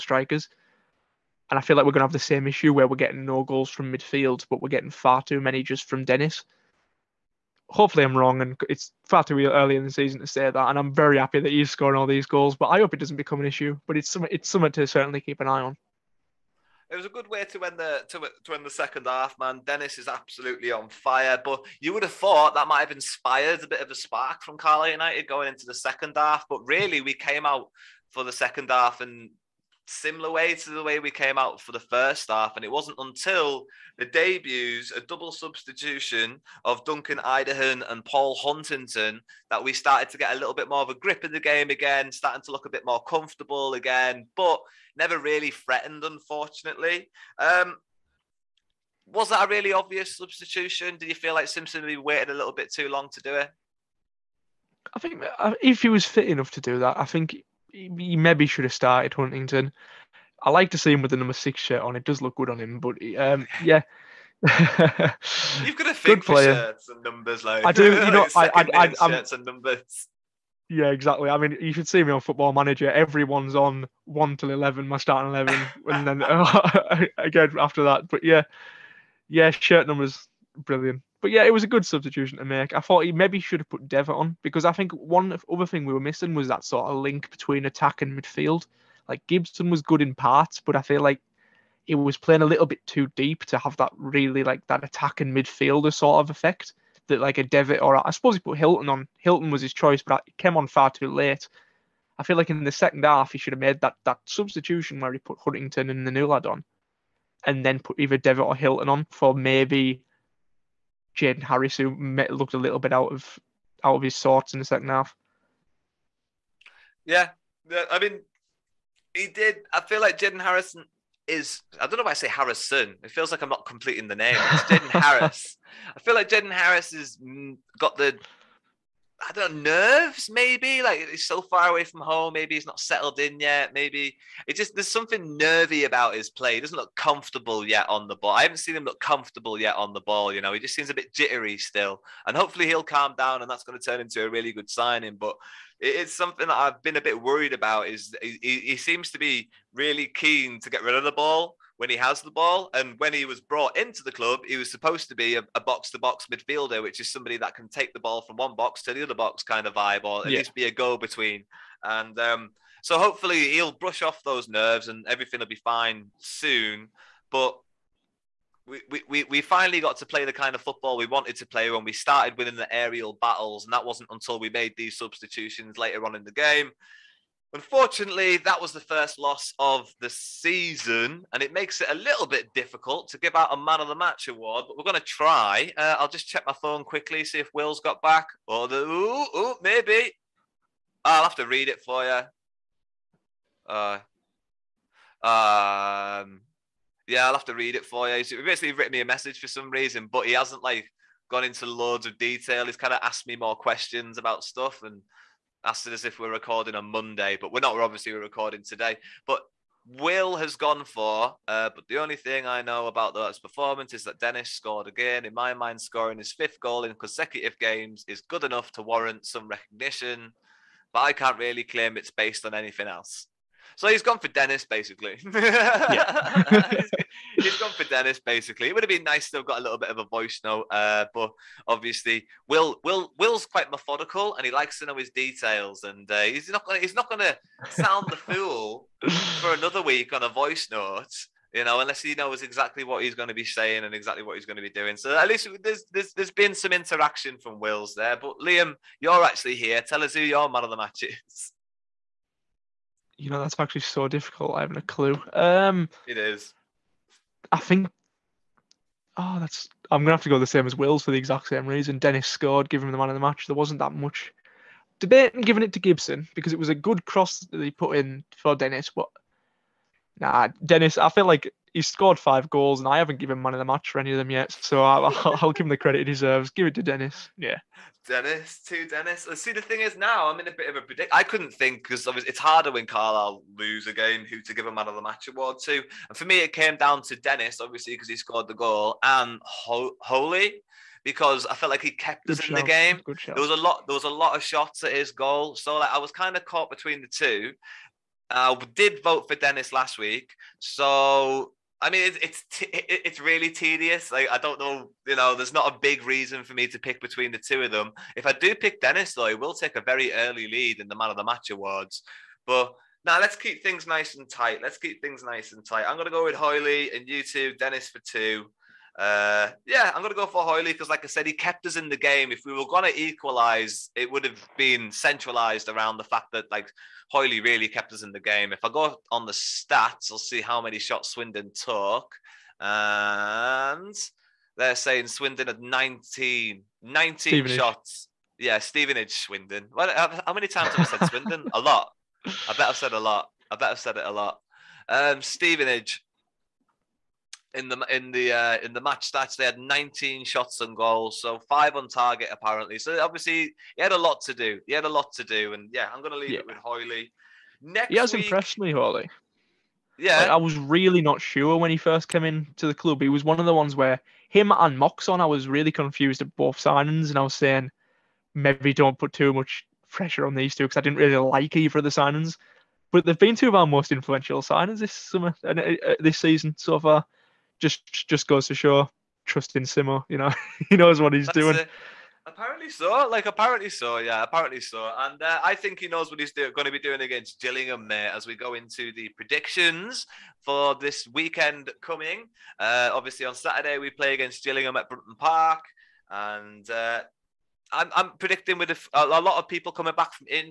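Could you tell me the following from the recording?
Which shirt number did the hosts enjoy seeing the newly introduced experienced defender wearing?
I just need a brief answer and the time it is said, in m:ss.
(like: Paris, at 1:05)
6, at 1:01.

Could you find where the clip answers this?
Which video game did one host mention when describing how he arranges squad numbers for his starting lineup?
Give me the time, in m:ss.
1:12.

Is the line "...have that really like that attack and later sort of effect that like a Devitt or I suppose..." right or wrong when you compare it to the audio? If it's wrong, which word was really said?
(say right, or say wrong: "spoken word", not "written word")
wrong: "midfielder", not "later".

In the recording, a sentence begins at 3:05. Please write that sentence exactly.
Uh, I'll just check my phone quickly, see if Will's got back.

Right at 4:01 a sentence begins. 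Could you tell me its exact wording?
You know, unless he knows exactly what he's going to be saying and exactly what he's going to be doing.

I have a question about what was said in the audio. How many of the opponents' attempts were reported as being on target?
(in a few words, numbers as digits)
5.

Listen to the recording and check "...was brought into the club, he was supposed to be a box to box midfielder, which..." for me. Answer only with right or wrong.
right.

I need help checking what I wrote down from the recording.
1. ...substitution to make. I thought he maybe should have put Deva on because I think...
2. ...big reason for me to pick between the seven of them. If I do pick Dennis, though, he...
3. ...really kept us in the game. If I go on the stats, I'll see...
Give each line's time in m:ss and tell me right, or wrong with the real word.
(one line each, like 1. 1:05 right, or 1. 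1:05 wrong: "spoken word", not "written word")
1. 1:21 right
2. 5:05 wrong: "two", not "seven"
3. 5:27 right.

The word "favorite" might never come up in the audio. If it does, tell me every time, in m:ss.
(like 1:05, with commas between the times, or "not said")
not said.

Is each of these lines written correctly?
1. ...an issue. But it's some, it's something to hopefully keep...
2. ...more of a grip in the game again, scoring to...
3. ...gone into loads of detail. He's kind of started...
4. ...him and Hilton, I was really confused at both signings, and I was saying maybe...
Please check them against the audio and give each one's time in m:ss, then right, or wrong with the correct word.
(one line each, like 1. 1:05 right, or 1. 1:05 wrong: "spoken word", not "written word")
1. 0:13 wrong: "certainly", not "hopefully"
2. 0:40 wrong: "starting", not "scoring"
3. 3:21 wrong: "asked", not "started"
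4. 6:04 wrong: "Moxon", not "Hilton".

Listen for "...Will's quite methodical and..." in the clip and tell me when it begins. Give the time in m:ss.
3:53.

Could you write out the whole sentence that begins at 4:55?
So like I was kind of caught between the two.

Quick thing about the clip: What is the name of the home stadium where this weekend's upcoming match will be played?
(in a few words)
Brunton Park.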